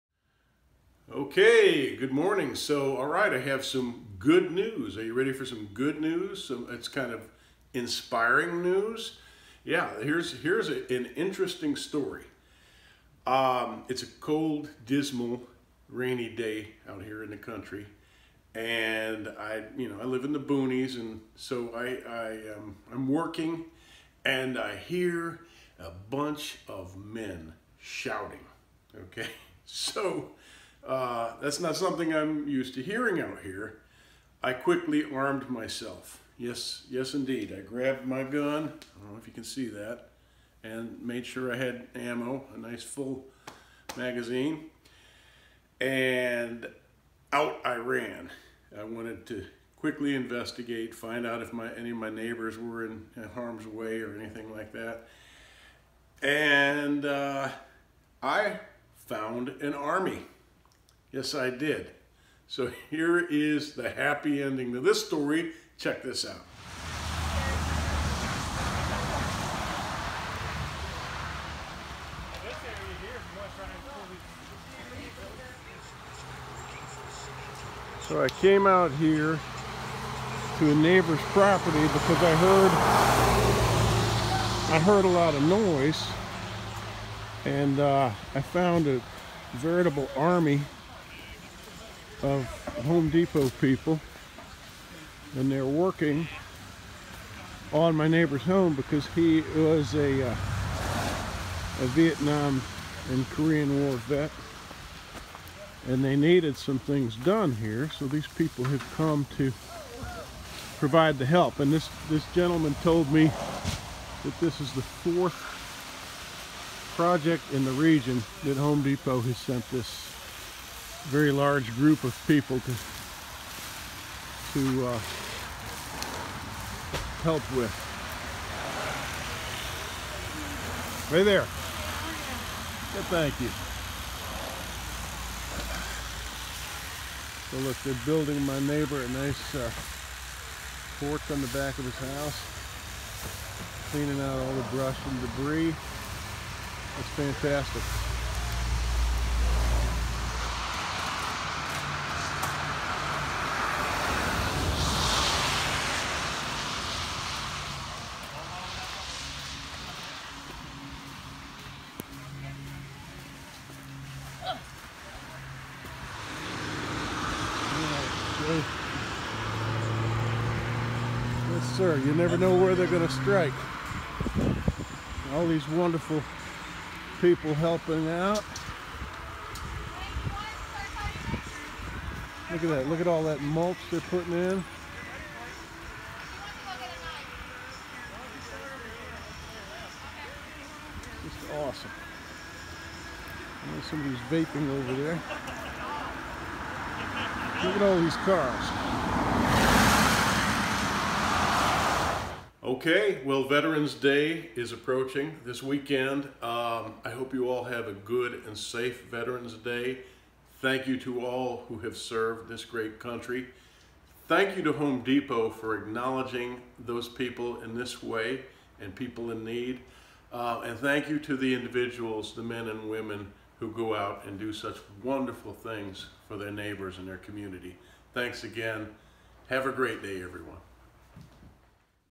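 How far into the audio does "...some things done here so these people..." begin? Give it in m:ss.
1:46.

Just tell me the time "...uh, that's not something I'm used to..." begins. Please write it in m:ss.
0:30.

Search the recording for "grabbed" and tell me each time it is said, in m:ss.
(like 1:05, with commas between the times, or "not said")
0:37.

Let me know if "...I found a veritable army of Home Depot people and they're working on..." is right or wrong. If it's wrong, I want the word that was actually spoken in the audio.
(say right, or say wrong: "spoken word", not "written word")
right.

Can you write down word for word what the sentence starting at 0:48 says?
I wanted to quickly investigate, find out if my, any of my neighbors were in, in harm's way or anything like that.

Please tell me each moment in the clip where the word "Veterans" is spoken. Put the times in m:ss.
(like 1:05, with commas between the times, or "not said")
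3:23, 3:29.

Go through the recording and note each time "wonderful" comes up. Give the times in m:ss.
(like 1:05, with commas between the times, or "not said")
2:55, 3:45.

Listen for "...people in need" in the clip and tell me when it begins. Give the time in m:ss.
3:38.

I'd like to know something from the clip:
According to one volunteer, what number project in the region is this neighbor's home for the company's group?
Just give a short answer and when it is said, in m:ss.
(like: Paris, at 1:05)
Fourth, at 1:54.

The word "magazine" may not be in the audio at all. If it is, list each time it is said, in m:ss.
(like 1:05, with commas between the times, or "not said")
0:43.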